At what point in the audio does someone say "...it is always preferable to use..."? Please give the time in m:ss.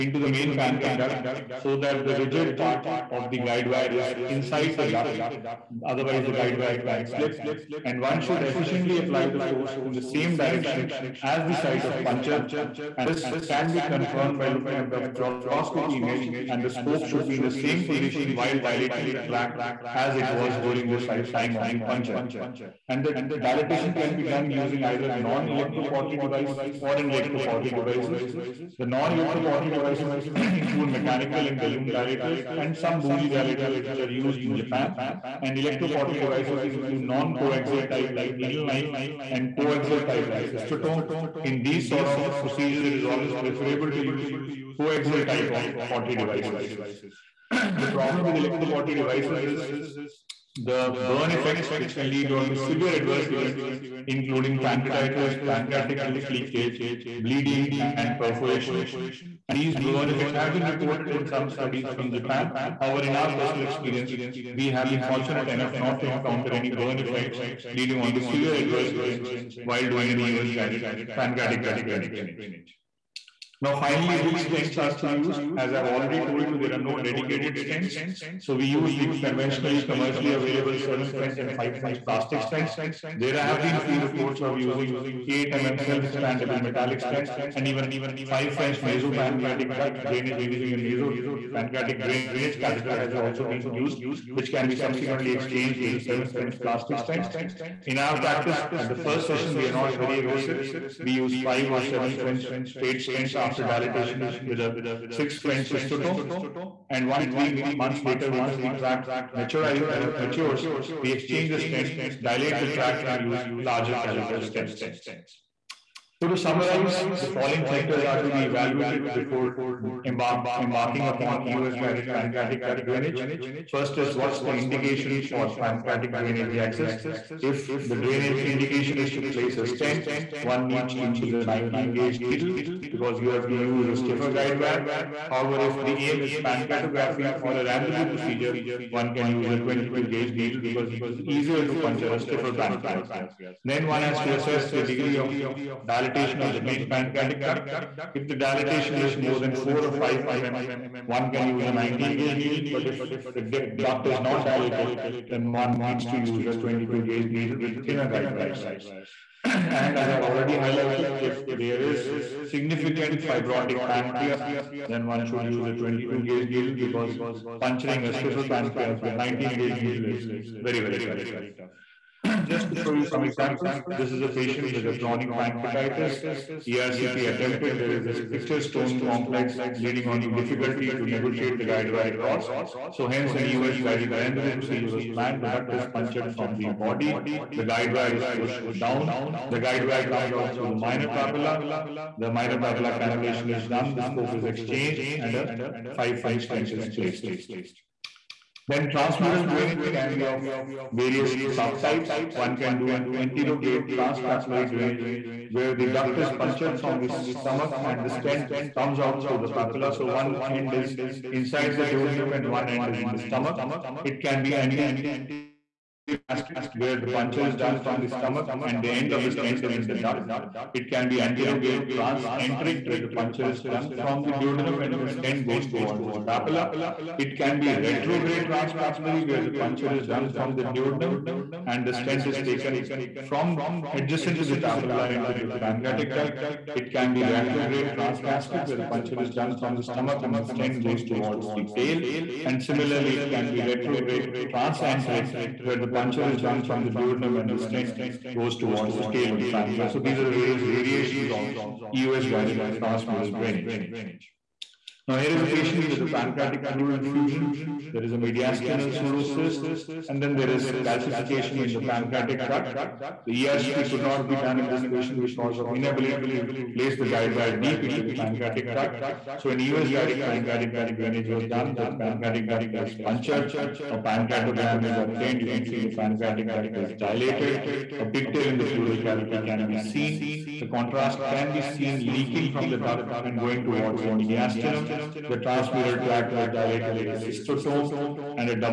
0:42.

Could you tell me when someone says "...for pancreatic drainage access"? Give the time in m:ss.
2:05.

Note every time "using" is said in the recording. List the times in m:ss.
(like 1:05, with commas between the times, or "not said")
0:24, 1:24, 1:30.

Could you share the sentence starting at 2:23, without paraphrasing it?
Then one has to assess the degree of dilatation of the main pancreatic duct.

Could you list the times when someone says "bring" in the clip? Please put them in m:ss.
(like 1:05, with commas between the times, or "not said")
not said.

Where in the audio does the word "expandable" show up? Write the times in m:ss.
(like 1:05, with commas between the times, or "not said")
1:25.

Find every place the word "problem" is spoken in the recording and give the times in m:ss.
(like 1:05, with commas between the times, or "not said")
0:47.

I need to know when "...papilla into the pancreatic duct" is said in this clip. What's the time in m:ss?
3:54.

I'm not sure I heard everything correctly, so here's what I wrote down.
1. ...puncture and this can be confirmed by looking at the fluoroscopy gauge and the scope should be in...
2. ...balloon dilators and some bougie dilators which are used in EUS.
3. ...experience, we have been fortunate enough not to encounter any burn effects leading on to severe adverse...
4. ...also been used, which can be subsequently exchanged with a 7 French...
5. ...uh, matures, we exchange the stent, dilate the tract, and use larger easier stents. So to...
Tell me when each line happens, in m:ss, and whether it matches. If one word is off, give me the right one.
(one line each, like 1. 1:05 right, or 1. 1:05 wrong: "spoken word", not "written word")
1. 0:12 wrong: "image", not "gauge"
2. 0:31 wrong: "Japan", not "EUS"
3. 1:03 right
4. 1:33 right
5. 1:49 wrong: "caliber", not "easier".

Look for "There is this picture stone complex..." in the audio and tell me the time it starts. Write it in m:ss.
2:57.